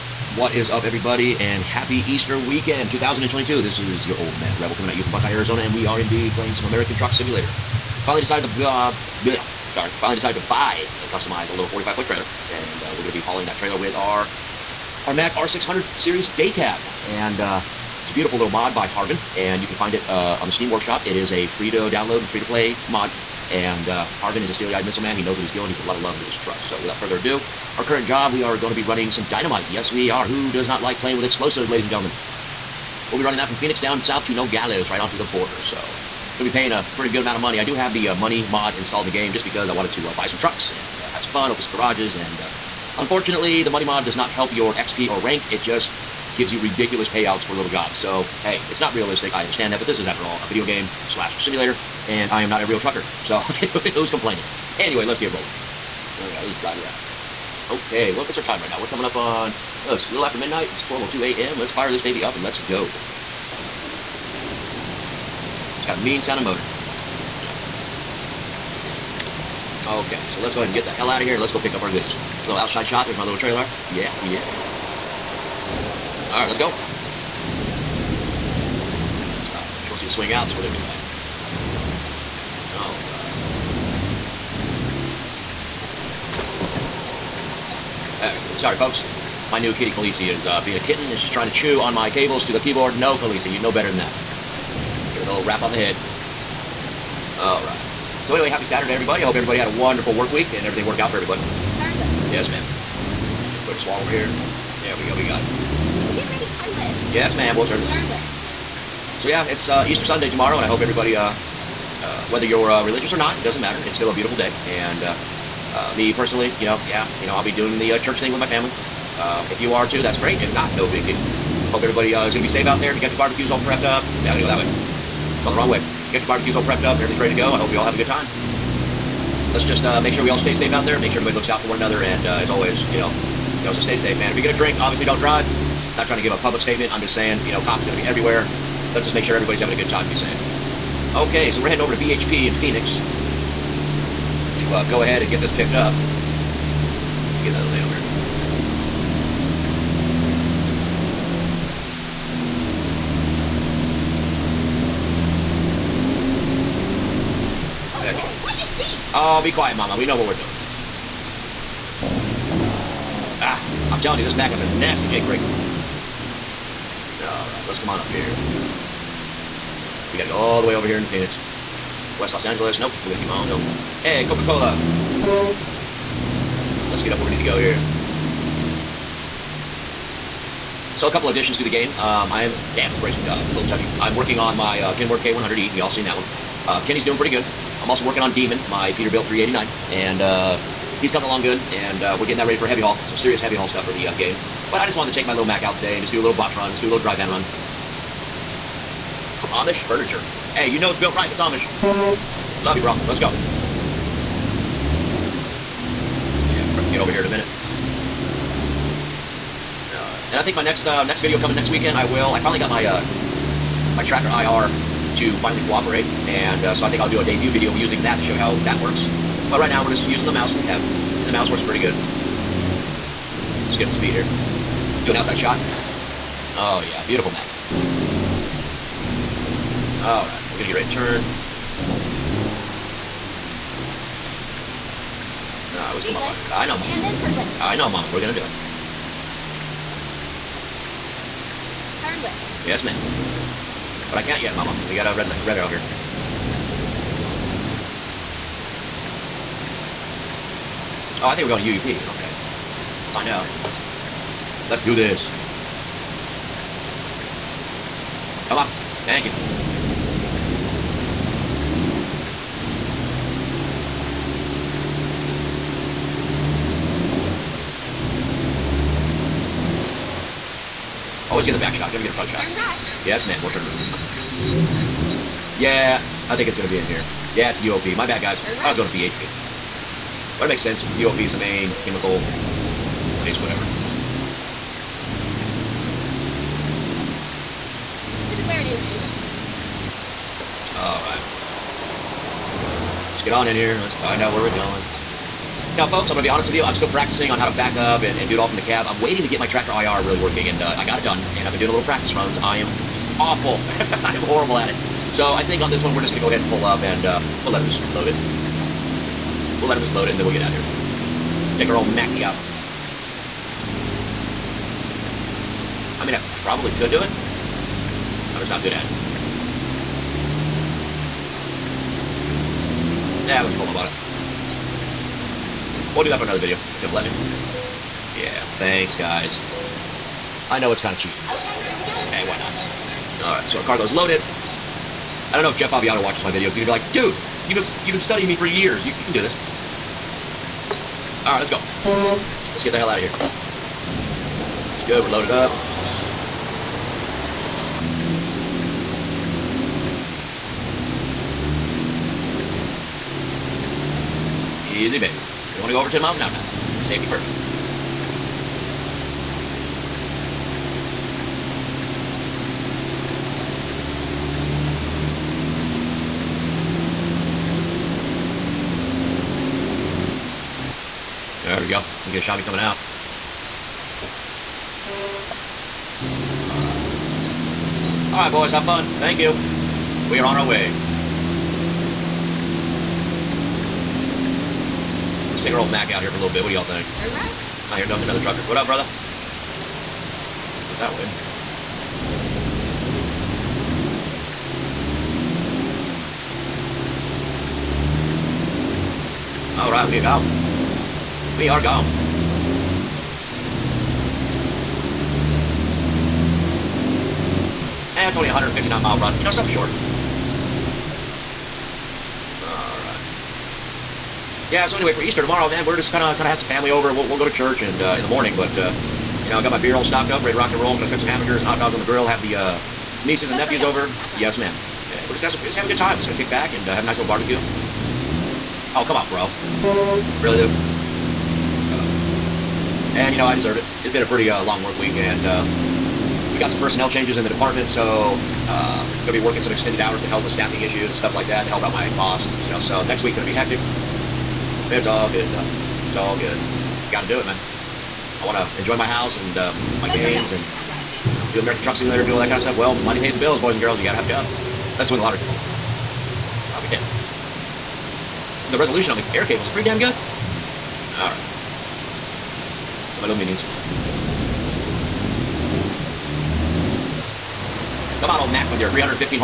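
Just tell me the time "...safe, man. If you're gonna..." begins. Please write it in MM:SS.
02:13.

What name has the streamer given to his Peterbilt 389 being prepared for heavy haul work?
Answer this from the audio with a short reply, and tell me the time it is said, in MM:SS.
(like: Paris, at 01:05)
Demon, at 03:08.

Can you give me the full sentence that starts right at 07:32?
Well, money pays the bills, boys and girls.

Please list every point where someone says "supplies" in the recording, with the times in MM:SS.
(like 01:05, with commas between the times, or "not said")
not said.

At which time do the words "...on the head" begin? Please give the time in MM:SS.
01:35.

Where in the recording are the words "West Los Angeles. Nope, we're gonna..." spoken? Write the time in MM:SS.
02:52.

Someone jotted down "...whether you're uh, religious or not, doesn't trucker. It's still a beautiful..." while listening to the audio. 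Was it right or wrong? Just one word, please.
wrong.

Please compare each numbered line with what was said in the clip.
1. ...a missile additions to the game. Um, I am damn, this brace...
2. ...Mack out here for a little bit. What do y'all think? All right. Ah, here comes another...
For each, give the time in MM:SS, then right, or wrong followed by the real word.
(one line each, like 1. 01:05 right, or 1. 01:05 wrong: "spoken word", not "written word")
1. 03:01 wrong: "couple", not "missile"
2. 06:25 right.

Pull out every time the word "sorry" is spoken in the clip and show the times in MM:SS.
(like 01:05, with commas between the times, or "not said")
00:09, 01:28.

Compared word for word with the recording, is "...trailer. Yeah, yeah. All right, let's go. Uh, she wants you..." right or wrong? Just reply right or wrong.
right.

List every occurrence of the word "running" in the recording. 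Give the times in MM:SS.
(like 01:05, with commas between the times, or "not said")
00:28, 00:33.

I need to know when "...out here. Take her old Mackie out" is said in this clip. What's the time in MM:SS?
05:10.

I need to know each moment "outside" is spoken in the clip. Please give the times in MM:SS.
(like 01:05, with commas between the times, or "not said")
01:12, 03:45.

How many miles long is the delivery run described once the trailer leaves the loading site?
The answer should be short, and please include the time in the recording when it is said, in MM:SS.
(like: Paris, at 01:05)
159, at 06:48.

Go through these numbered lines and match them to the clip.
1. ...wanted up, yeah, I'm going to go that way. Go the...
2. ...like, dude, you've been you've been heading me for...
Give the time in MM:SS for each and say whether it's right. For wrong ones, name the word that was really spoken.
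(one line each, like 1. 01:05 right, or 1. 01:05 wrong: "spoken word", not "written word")
1. 02:03 wrong: "prepped", not "wanted"
2. 05:36 wrong: "studying", not "heading".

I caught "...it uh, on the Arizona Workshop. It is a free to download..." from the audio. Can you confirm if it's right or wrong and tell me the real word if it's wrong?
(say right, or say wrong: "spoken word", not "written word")
wrong: "Steam", not "Arizona".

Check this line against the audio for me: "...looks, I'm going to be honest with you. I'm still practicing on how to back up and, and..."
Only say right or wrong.
wrong.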